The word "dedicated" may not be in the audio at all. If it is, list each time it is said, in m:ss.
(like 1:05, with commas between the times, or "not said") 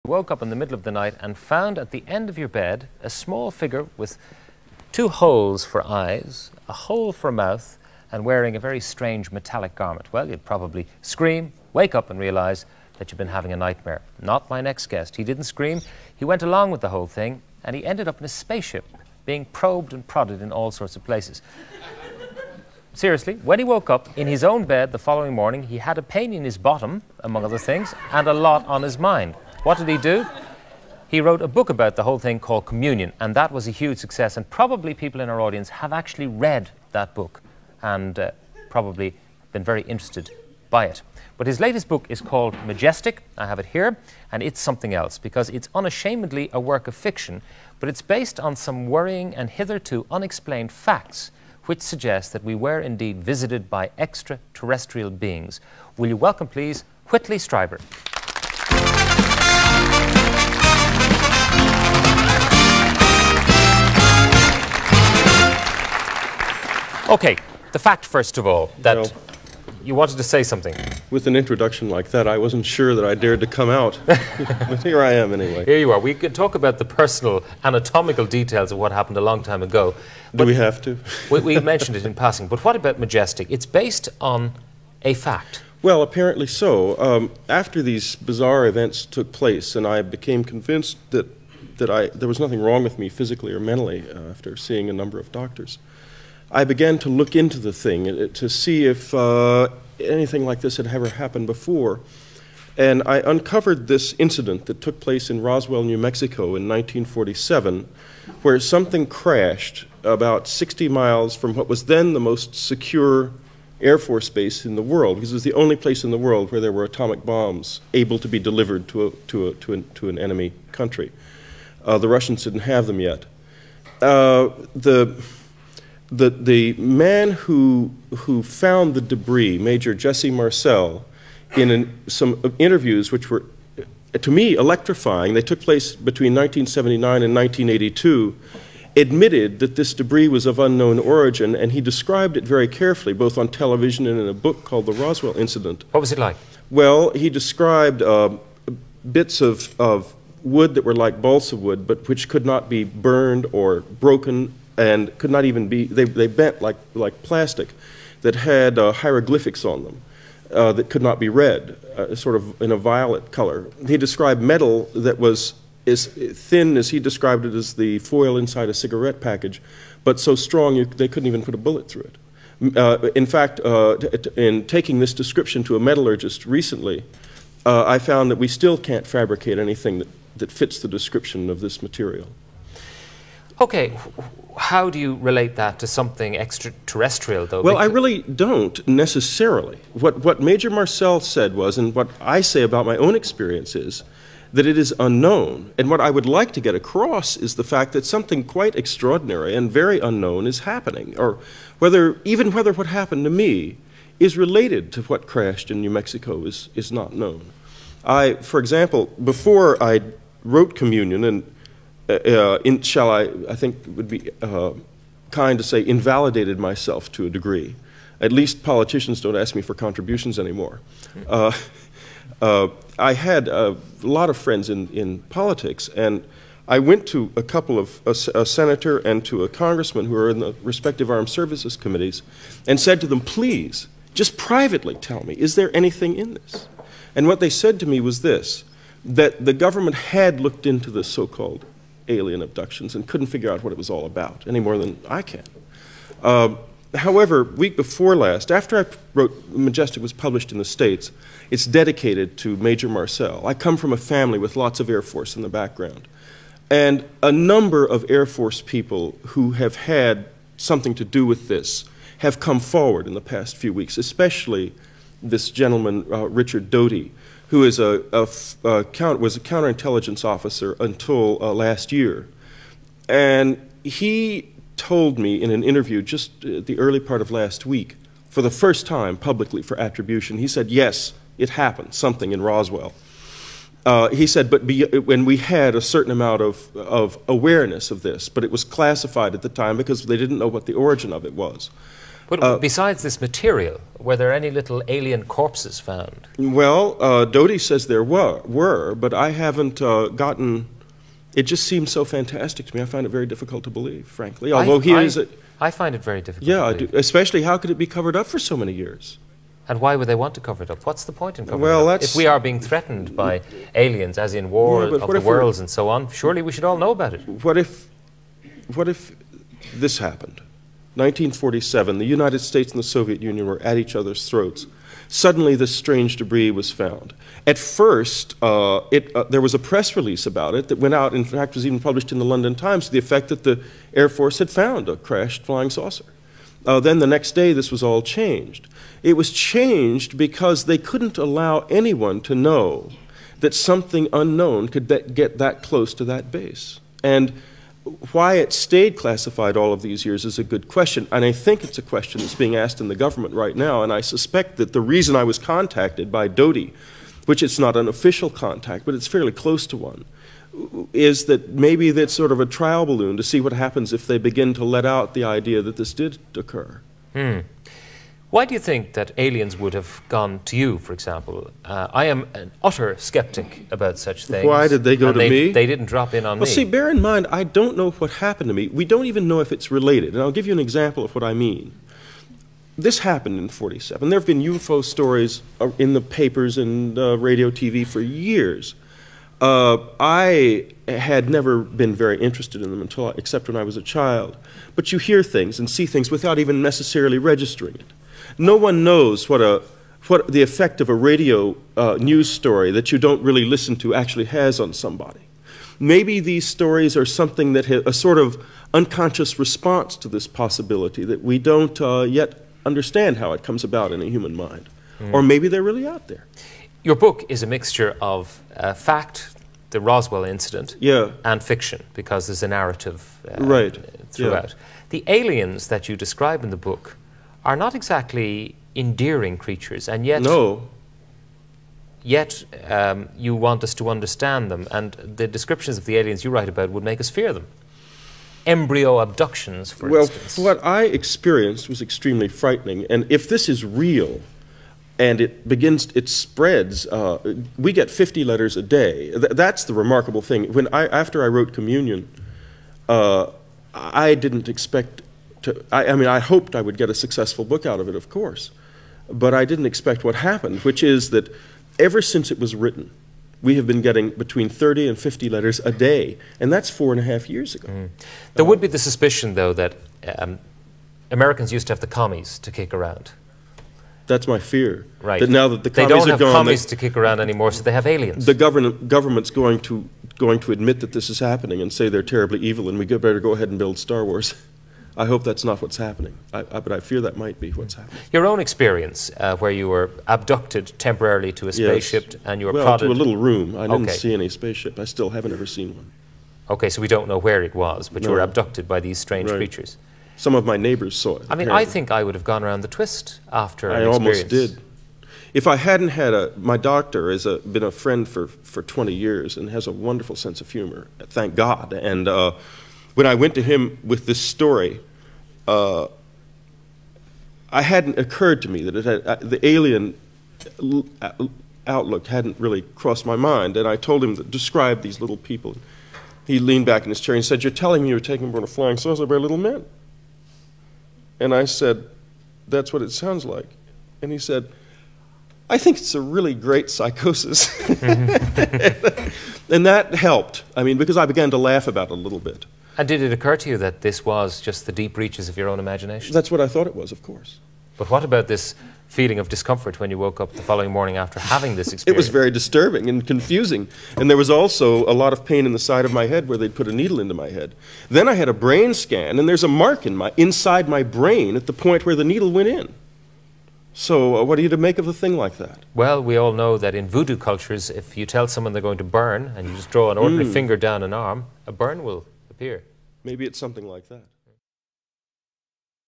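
4:11.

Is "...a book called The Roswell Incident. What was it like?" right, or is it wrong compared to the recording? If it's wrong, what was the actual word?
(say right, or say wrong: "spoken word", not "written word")
right.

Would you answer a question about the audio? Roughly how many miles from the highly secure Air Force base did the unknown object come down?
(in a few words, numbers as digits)
60 miles.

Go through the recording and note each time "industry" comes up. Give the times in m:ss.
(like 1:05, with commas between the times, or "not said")
not said.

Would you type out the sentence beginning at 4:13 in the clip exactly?
I come from a family with lots of Air Force in the background.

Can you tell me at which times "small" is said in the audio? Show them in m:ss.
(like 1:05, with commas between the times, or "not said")
0:03.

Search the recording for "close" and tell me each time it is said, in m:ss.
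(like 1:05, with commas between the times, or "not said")
5:45, 5:59.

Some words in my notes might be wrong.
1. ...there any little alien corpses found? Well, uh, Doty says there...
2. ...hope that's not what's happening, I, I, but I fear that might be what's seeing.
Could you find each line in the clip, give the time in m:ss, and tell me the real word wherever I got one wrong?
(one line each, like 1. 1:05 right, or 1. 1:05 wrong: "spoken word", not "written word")
1. 4:54 right
2. 8:05 wrong: "happening", not "seeing".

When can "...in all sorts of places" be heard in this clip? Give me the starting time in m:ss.
0:20.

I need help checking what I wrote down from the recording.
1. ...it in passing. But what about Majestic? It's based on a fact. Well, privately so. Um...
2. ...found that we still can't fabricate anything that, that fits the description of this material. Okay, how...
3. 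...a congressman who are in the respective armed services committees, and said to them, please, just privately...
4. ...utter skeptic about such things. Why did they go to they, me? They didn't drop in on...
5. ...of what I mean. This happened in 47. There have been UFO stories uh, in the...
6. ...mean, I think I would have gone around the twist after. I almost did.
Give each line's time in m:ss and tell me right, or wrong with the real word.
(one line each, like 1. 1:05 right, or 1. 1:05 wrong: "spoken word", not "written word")
1. 1:21 wrong: "apparently", not "privately"
2. 2:57 right
3. 3:49 right
4. 6:12 right
5. 6:21 right
6. 8:21 right.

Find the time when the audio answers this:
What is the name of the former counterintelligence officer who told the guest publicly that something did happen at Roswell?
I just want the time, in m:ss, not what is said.
4:26.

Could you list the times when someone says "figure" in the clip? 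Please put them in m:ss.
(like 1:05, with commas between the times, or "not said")
0:03, 4:03.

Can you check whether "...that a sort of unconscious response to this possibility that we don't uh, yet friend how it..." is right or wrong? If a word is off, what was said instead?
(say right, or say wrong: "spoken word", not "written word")
wrong: "understand", not "friend".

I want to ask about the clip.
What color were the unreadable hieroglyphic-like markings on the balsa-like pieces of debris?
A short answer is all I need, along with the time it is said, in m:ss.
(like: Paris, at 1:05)
violet, at 2:42.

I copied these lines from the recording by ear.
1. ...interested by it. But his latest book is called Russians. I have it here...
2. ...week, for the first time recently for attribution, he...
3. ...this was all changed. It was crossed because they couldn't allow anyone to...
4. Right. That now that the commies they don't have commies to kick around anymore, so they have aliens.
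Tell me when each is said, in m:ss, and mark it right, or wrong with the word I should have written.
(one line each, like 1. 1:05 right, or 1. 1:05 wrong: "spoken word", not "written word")
1. 0:39 wrong: "Majestic", not "Russians"
2. 4:37 wrong: "publicly", not "recently"
3. 5:37 wrong: "changed", not "crossed"
4. 7:55 right.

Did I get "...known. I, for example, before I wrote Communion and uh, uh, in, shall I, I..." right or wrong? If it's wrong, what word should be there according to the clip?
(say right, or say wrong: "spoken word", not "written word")
right.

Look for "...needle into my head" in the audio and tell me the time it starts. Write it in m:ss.
9:16.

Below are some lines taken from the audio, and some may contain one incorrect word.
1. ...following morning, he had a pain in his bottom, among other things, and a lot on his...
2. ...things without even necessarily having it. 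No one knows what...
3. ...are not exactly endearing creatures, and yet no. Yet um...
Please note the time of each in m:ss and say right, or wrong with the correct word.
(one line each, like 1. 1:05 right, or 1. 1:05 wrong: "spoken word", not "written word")
1. 0:24 right
2. 6:35 wrong: "registering", not "having"
3. 7:07 right.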